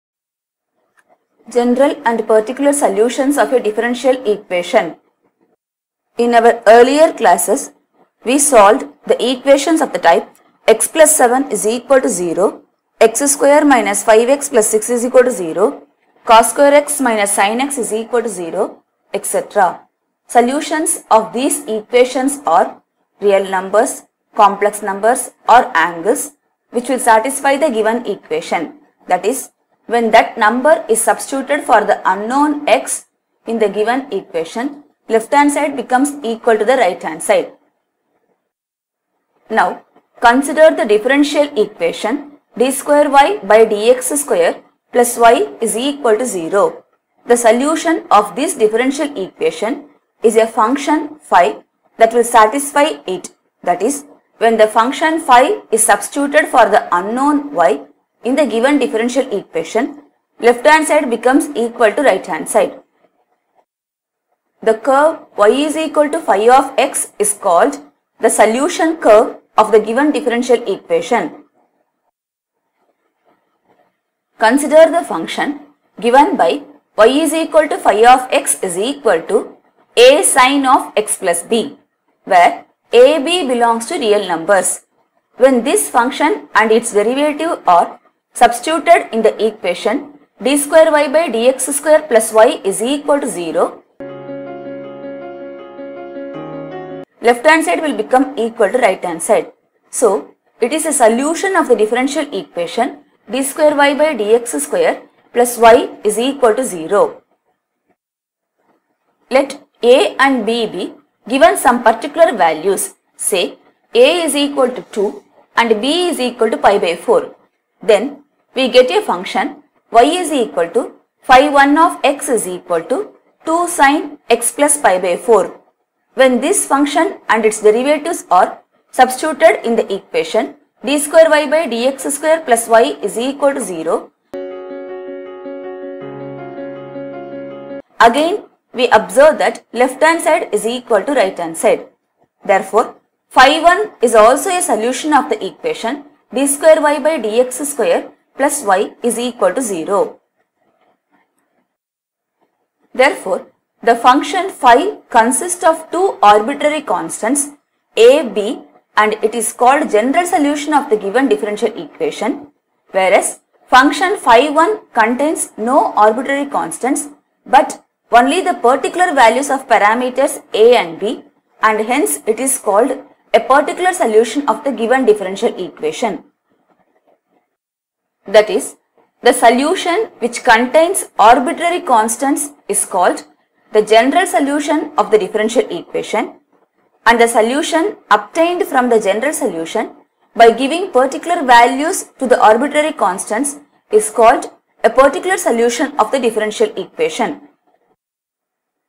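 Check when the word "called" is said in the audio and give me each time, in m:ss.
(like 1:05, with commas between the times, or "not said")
1:07, 2:39, 2:52, 3:02, 3:14.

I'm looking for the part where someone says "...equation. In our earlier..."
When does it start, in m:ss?
0:04.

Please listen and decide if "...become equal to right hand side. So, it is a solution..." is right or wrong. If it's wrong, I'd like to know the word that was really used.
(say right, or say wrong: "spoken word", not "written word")
right.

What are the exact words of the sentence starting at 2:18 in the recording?
Again, we observe that left hand side is equal to right hand side.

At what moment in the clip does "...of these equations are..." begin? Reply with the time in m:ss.
0:21.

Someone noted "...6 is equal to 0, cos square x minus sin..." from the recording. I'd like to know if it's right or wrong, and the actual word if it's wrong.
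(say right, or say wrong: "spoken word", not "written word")
right.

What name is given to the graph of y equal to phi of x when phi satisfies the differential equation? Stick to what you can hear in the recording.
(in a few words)
solution curve.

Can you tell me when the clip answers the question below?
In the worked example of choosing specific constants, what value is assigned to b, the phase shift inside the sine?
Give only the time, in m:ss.
1:55.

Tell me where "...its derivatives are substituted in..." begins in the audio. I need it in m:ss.
2:07.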